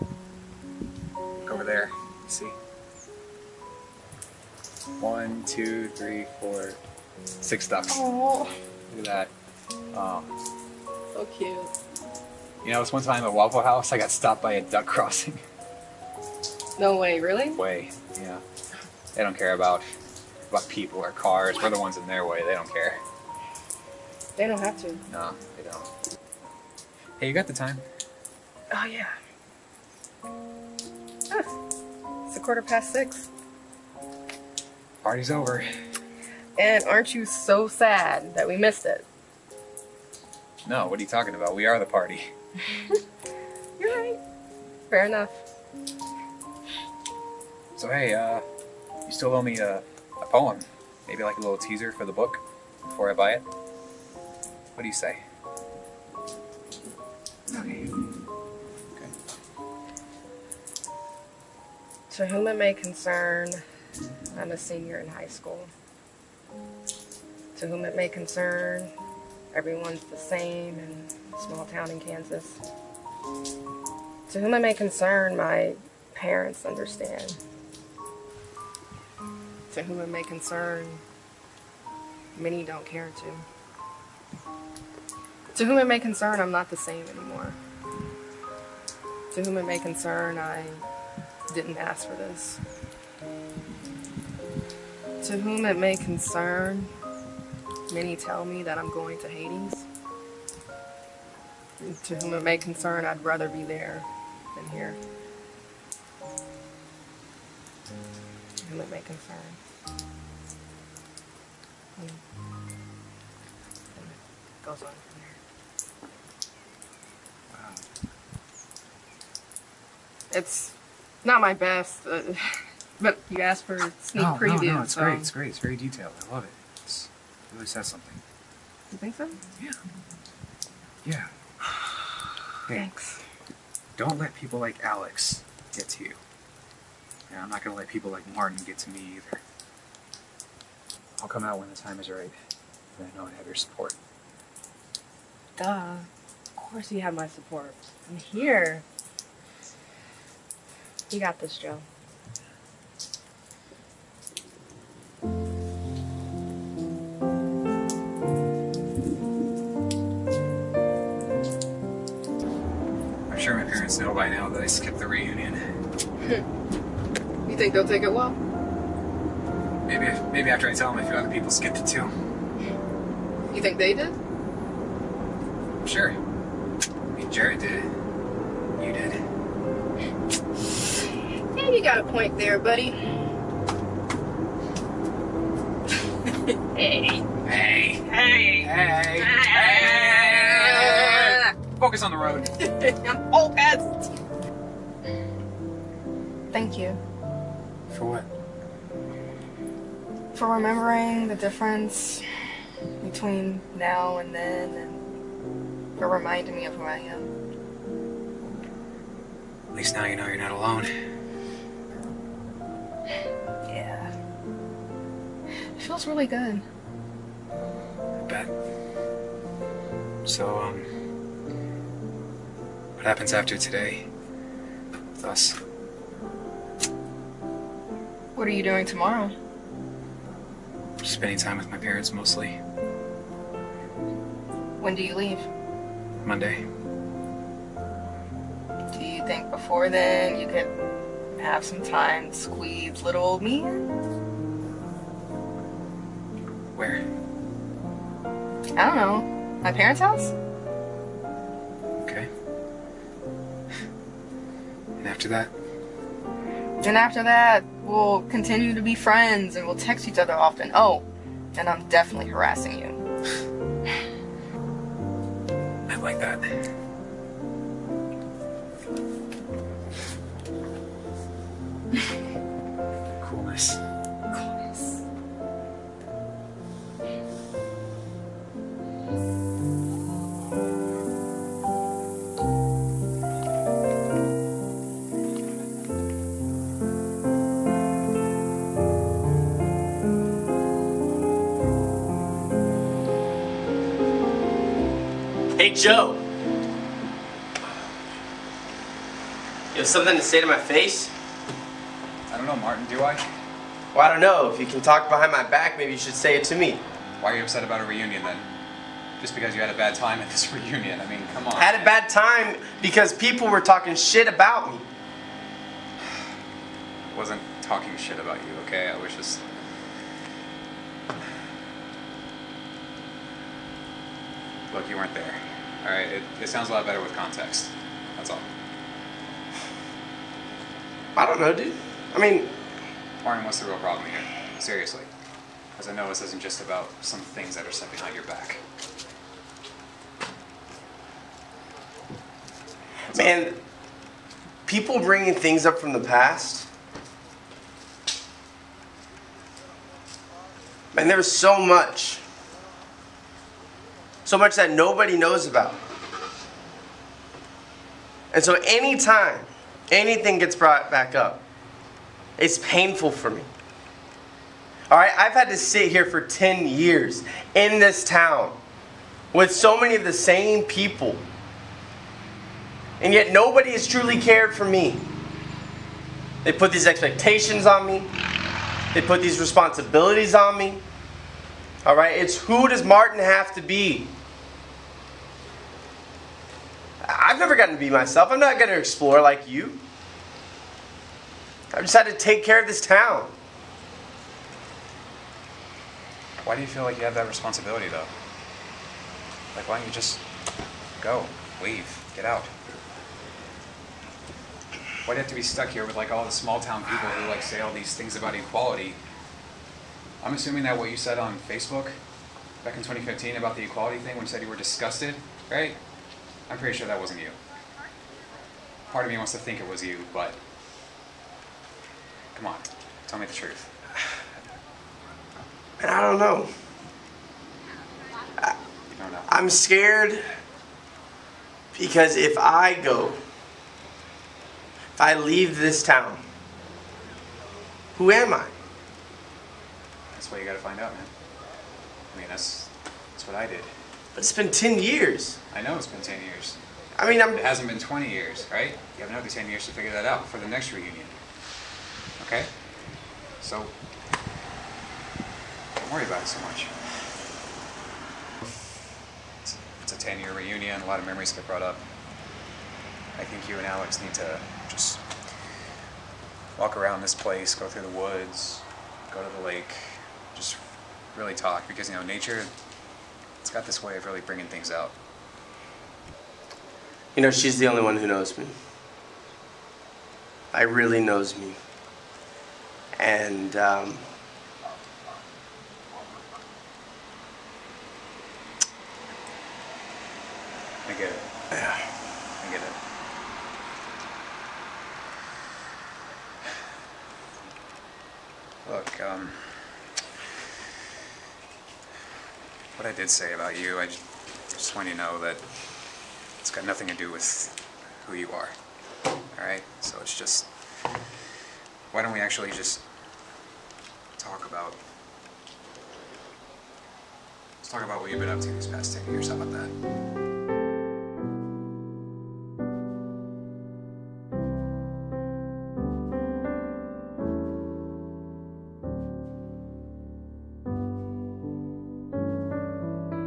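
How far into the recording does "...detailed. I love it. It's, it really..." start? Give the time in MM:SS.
02:05.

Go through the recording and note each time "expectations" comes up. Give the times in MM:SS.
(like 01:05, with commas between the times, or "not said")
06:16.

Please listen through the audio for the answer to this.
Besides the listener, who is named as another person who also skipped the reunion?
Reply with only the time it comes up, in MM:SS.
02:57.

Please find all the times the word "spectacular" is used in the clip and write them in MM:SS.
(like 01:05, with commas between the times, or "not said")
not said.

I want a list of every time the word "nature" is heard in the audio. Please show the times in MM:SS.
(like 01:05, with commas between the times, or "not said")
07:52.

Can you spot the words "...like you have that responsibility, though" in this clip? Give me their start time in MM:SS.
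06:36.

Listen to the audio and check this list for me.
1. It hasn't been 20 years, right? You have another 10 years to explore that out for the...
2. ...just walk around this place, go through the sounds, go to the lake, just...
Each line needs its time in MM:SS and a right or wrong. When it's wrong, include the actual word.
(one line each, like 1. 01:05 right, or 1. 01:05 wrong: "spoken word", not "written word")
1. 07:27 wrong: "figure", not "explore"
2. 07:44 wrong: "woods", not "sounds".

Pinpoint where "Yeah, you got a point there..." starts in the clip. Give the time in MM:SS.
03:01.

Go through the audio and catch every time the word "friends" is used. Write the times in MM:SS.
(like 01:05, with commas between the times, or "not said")
04:18.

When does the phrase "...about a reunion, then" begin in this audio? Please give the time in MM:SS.
05:07.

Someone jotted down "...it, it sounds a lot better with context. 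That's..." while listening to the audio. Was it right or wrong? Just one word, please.
right.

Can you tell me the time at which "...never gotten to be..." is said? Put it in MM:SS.
06:27.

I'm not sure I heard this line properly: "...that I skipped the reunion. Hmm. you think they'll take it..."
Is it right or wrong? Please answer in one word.
right.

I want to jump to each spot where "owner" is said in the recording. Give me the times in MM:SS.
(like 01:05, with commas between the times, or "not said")
not said.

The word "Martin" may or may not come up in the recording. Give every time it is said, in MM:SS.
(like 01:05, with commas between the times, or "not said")
02:18, 05:02, 06:22.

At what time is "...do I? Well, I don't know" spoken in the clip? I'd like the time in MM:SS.
05:02.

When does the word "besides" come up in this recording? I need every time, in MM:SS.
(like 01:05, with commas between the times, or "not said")
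not said.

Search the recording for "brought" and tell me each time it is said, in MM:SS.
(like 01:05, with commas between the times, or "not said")
06:00, 07:41.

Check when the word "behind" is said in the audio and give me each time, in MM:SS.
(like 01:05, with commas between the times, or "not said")
05:05, 05:37.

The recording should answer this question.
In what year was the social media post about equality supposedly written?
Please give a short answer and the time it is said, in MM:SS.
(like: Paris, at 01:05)
2015, at 06:52.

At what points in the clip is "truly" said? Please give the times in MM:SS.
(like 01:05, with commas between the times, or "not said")
06:13.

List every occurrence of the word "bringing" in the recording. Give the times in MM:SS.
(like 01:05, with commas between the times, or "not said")
05:45, 07:54.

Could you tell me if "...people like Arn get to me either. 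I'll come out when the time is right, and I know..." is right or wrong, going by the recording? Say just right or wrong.
wrong.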